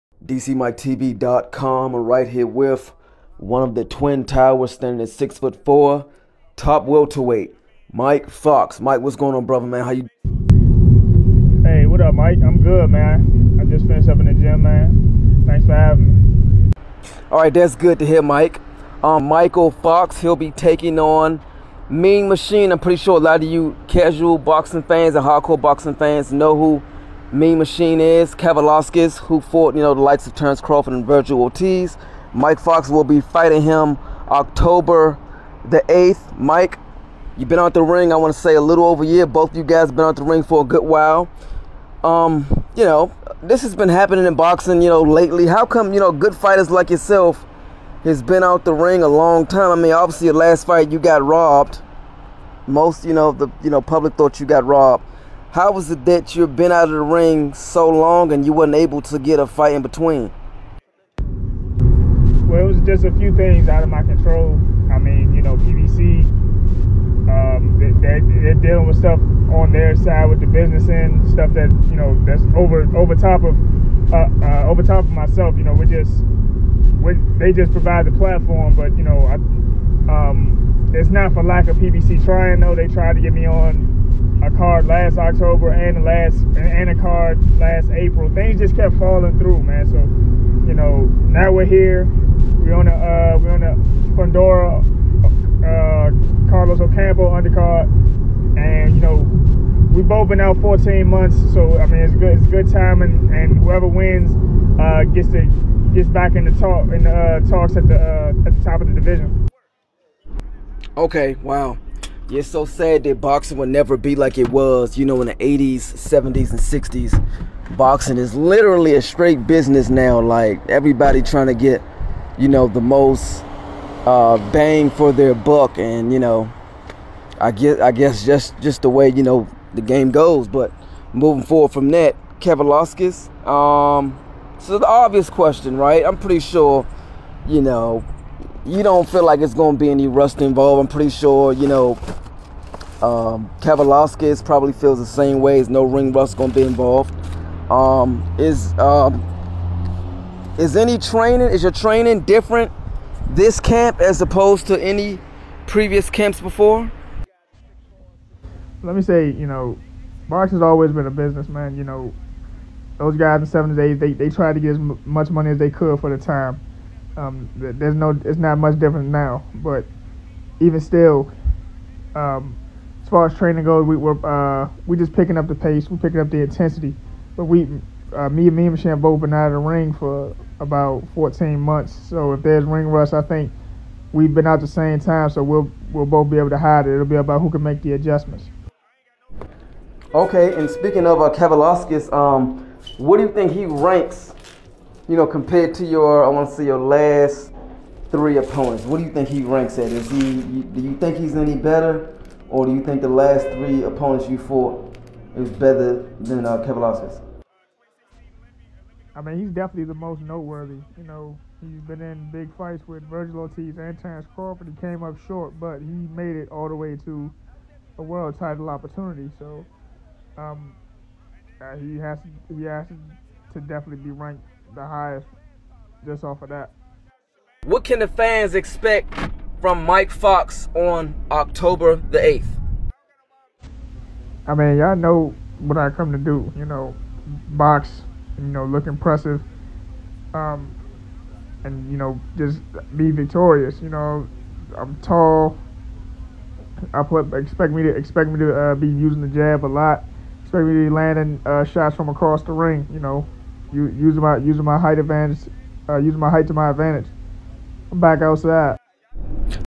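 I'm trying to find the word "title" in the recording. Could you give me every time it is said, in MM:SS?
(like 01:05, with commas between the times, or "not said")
03:38.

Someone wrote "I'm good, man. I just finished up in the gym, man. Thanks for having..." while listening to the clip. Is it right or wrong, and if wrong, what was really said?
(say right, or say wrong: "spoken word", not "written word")
right.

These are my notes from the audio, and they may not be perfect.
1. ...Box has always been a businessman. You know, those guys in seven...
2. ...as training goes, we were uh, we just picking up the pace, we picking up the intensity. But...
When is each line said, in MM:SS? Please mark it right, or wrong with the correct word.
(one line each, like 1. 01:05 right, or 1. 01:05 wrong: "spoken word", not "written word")
1. 02:40 right
2. 02:53 right.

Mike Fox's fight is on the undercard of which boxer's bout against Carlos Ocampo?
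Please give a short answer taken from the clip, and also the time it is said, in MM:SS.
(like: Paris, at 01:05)
Fundora, at 01:34.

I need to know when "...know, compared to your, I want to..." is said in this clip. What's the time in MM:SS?
03:15.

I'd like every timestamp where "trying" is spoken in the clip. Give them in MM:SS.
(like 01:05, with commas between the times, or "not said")
01:22, 02:01.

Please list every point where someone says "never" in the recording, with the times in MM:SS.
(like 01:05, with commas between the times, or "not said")
01:53.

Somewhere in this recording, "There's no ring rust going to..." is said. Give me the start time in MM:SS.
02:25.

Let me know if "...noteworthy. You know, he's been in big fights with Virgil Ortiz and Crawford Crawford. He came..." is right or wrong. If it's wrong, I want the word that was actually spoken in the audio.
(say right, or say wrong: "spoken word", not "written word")
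wrong: "Terrence", not "Crawford".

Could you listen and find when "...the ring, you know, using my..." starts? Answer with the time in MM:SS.
04:12.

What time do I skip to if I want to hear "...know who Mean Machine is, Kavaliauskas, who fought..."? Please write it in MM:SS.
00:26.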